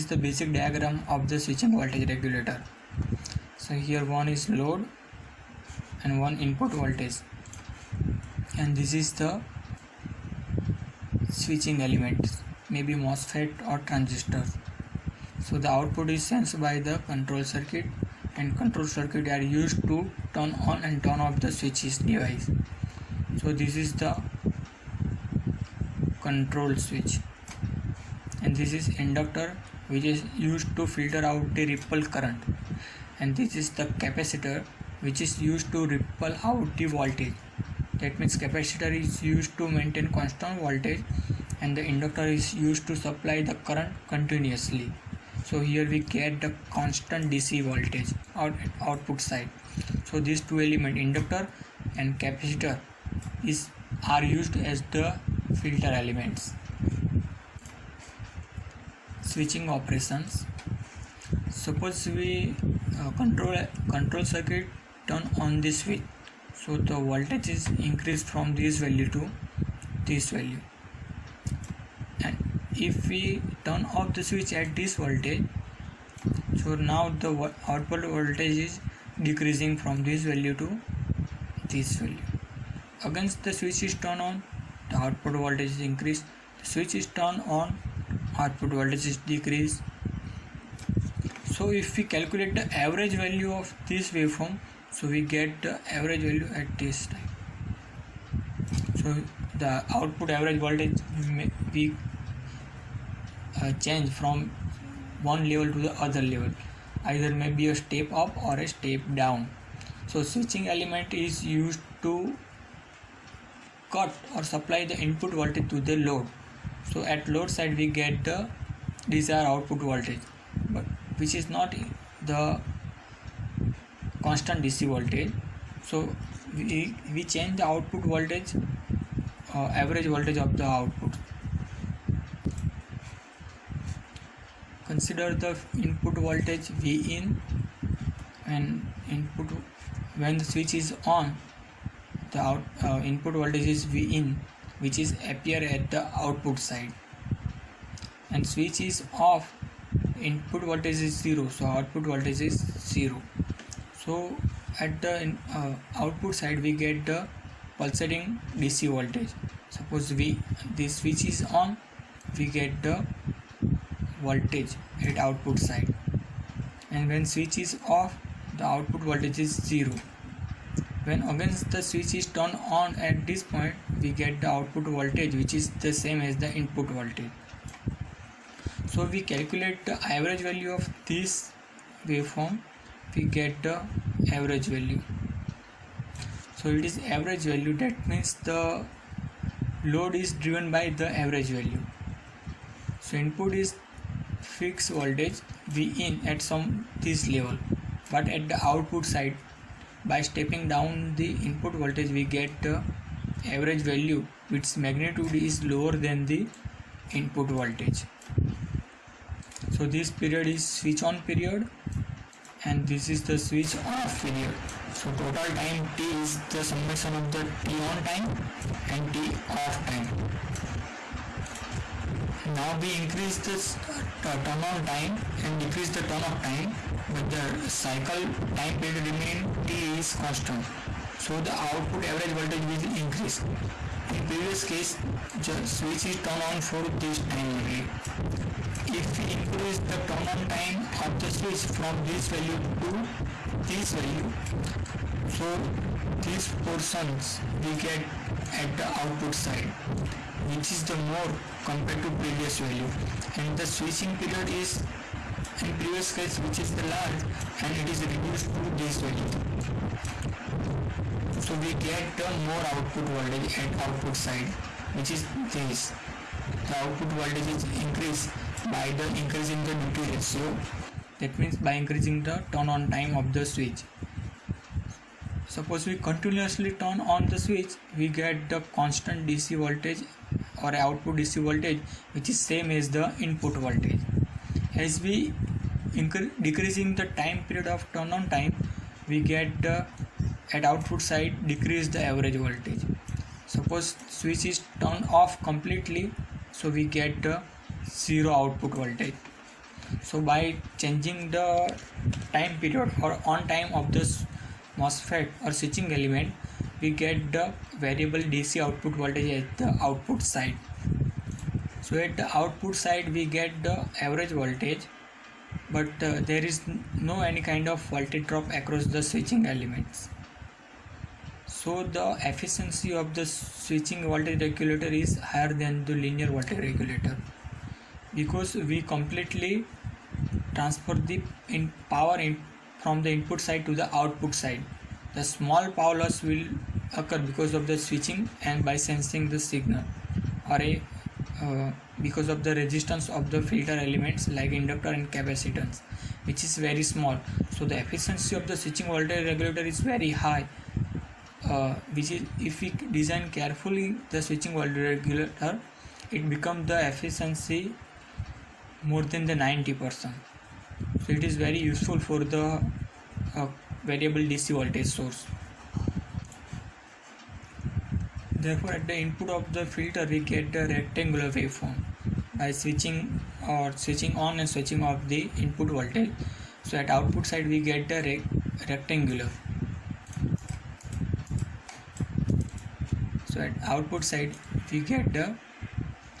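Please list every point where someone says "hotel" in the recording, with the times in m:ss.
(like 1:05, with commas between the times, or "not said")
not said.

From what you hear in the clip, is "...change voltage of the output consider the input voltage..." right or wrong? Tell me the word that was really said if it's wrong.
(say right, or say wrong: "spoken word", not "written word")
wrong: "average", not "change".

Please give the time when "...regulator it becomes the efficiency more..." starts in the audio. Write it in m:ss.
5:54.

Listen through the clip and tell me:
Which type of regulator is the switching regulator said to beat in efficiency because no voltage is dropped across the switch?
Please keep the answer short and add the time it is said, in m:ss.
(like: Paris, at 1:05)
Linear voltage regulator, at 5:26.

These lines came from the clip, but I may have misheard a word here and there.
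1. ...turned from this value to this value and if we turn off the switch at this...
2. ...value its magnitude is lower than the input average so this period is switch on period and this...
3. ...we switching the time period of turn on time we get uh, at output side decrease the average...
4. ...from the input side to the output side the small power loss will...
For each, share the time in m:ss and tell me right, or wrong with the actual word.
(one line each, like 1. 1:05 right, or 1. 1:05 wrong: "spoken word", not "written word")
1. 1:07 wrong: "increased", not "turned"
2. 3:23 wrong: "voltage", not "average"
3. 4:45 wrong: "decreasing", not "switching"
4. 5:32 right.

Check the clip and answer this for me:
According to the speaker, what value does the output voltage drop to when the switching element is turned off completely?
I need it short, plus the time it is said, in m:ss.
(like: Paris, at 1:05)
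0, at 4:58.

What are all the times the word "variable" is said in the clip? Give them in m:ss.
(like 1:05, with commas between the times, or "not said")
5:07, 6:03.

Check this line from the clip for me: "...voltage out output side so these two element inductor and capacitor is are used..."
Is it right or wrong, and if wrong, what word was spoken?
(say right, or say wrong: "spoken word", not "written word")
right.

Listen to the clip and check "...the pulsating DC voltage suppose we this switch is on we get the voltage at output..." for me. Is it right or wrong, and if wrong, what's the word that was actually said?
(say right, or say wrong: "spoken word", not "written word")
right.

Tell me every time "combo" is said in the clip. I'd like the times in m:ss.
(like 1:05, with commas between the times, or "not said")
not said.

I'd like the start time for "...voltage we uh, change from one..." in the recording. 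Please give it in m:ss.
1:40.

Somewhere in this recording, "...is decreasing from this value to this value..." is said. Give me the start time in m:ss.
1:18.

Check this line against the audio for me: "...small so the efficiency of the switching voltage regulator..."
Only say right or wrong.
right.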